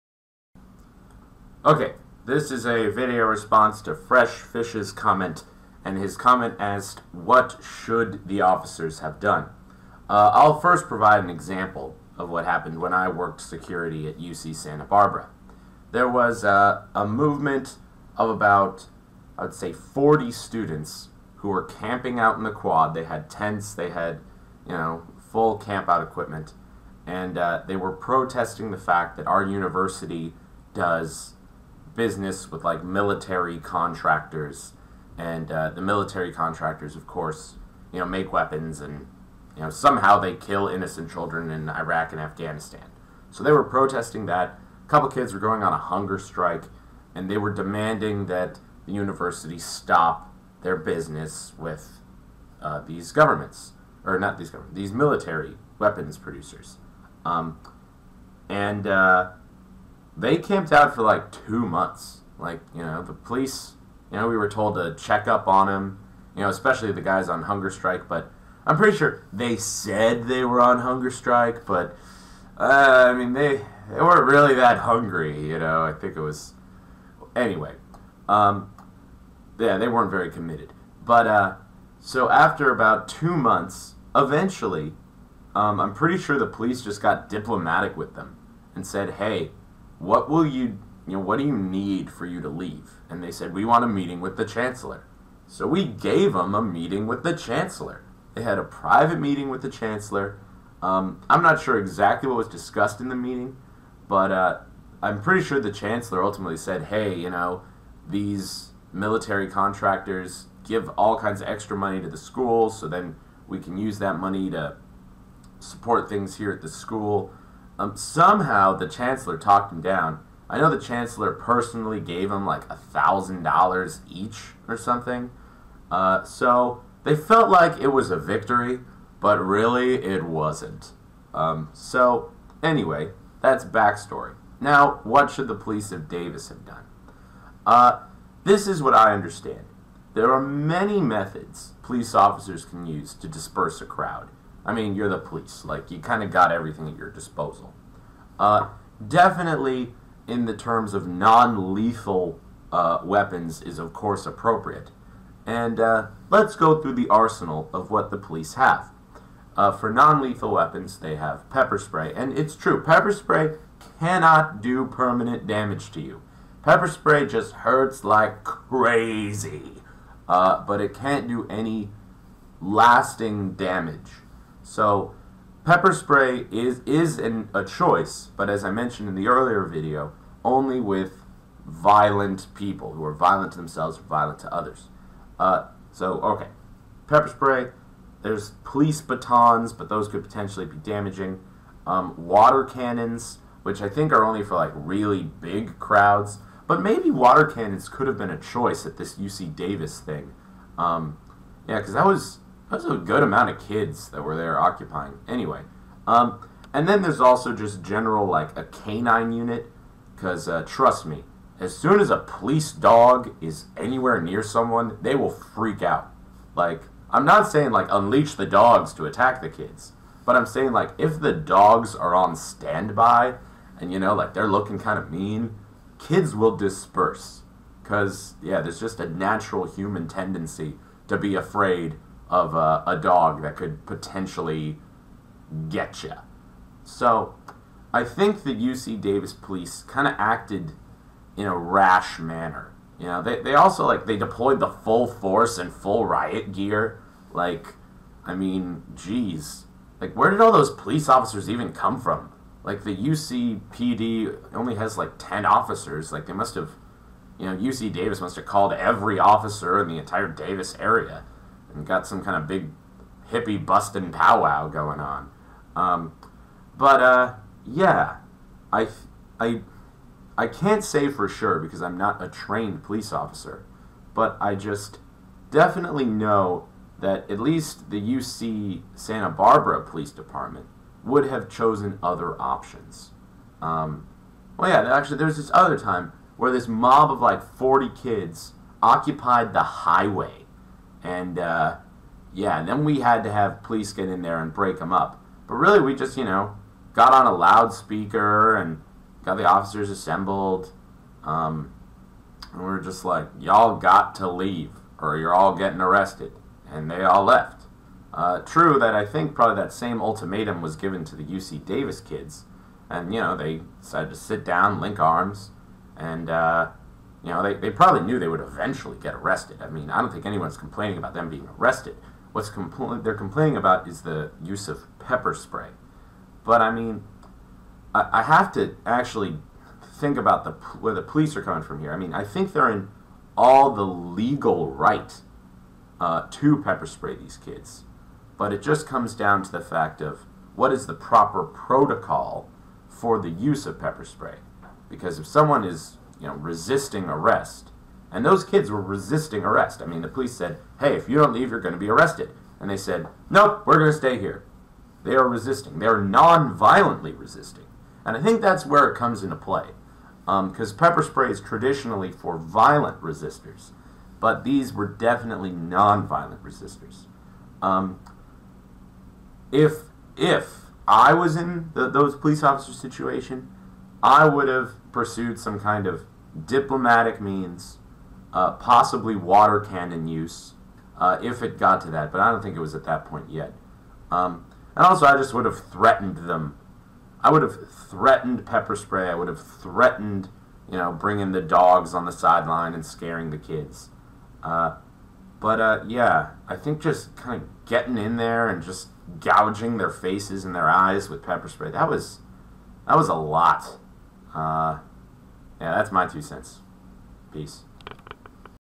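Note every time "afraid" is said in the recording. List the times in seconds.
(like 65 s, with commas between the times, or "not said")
231 s.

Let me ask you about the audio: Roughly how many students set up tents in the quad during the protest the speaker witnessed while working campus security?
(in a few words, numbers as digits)
40.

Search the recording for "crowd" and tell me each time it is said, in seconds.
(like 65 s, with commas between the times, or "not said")
143 s, 195 s.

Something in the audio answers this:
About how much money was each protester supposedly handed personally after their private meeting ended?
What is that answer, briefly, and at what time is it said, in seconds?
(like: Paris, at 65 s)
$1,000, at 122 s.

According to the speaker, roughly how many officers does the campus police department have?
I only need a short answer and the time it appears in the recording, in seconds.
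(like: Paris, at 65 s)
10, at 255 s.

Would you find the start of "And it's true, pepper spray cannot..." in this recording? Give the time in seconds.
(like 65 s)
162 s.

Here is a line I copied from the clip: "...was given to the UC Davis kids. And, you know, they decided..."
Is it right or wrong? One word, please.
right.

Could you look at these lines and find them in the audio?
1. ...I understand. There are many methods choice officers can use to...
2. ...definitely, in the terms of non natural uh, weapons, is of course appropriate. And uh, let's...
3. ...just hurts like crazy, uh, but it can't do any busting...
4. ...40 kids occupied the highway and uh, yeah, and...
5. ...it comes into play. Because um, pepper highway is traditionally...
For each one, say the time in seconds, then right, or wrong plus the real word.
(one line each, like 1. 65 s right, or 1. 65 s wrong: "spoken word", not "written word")
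1. 138 s wrong: "police", not "choice"
2. 149 s wrong: "lethal", not "natural"
3. 167 s wrong: "lasting", not "busting"
4. 287 s right
5. 358 s wrong: "spray", not "highway".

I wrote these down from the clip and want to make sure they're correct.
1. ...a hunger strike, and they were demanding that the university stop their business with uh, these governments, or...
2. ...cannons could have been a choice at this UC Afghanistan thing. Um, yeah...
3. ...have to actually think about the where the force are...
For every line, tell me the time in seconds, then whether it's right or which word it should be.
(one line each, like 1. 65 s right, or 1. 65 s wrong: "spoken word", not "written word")
1. 45 s right
2. 197 s wrong: "Davis", not "Afghanistan"
3. 328 s wrong: "police", not "force".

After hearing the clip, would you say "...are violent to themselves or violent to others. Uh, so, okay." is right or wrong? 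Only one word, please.
right.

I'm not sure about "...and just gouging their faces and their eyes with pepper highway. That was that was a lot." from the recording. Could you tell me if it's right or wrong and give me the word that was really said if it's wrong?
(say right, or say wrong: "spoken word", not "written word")
wrong: "spray", not "highway".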